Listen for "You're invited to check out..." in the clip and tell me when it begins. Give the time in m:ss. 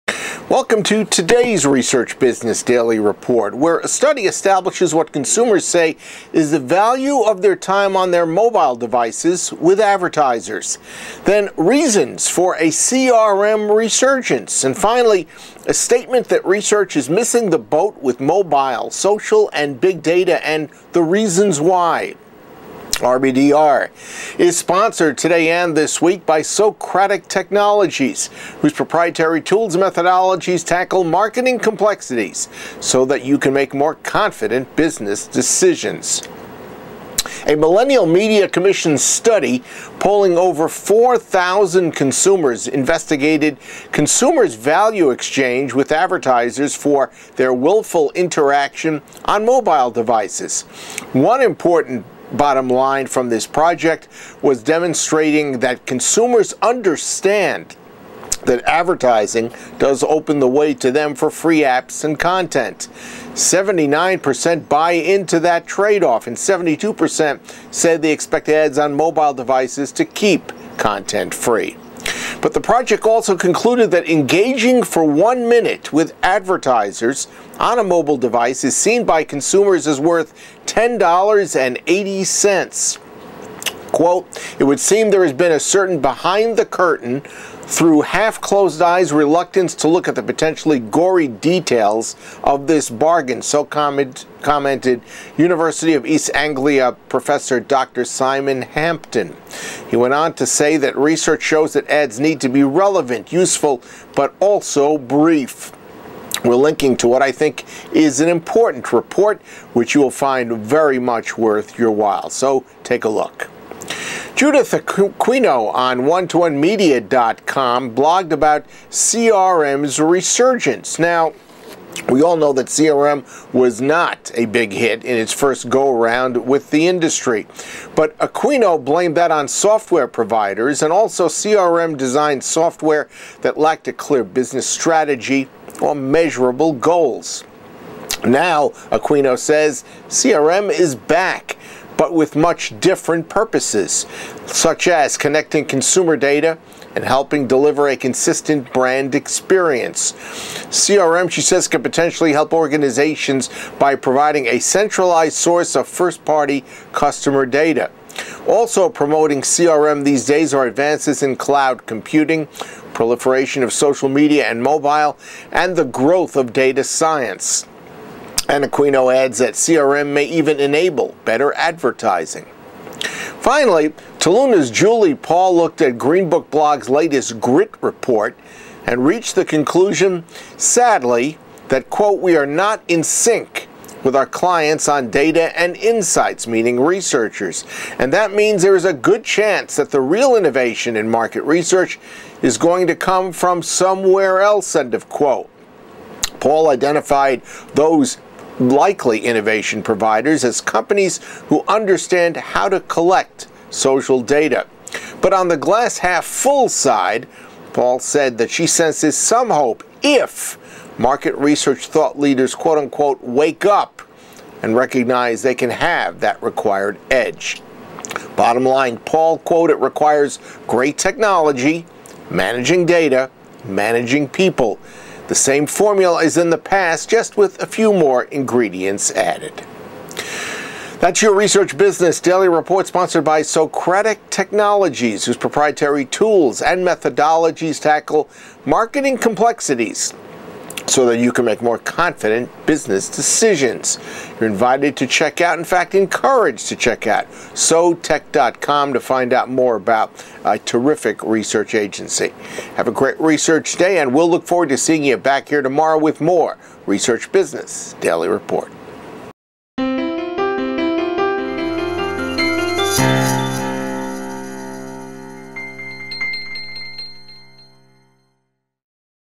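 4:04.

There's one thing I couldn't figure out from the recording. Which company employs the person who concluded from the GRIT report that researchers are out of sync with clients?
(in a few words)
Toluna.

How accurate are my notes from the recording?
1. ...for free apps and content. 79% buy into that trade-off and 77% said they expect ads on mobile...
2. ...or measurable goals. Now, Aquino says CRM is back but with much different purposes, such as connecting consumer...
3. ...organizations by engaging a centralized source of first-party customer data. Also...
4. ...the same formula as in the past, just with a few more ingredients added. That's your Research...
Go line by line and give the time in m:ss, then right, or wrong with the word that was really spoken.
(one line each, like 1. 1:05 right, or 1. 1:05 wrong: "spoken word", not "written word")
1. 1:01 wrong: "72", not "77"
2. 2:15 right
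3. 2:32 wrong: "providing", not "engaging"
4. 3:45 right.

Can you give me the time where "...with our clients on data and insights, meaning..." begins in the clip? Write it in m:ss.
3:04.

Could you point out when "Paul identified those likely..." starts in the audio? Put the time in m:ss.
3:16.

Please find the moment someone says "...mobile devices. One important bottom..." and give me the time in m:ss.
0:49.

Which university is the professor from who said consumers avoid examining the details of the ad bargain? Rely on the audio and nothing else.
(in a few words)
University of East Anglia.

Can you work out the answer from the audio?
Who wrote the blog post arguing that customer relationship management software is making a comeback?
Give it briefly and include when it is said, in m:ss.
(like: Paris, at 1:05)
Judith Aquino, at 1:54.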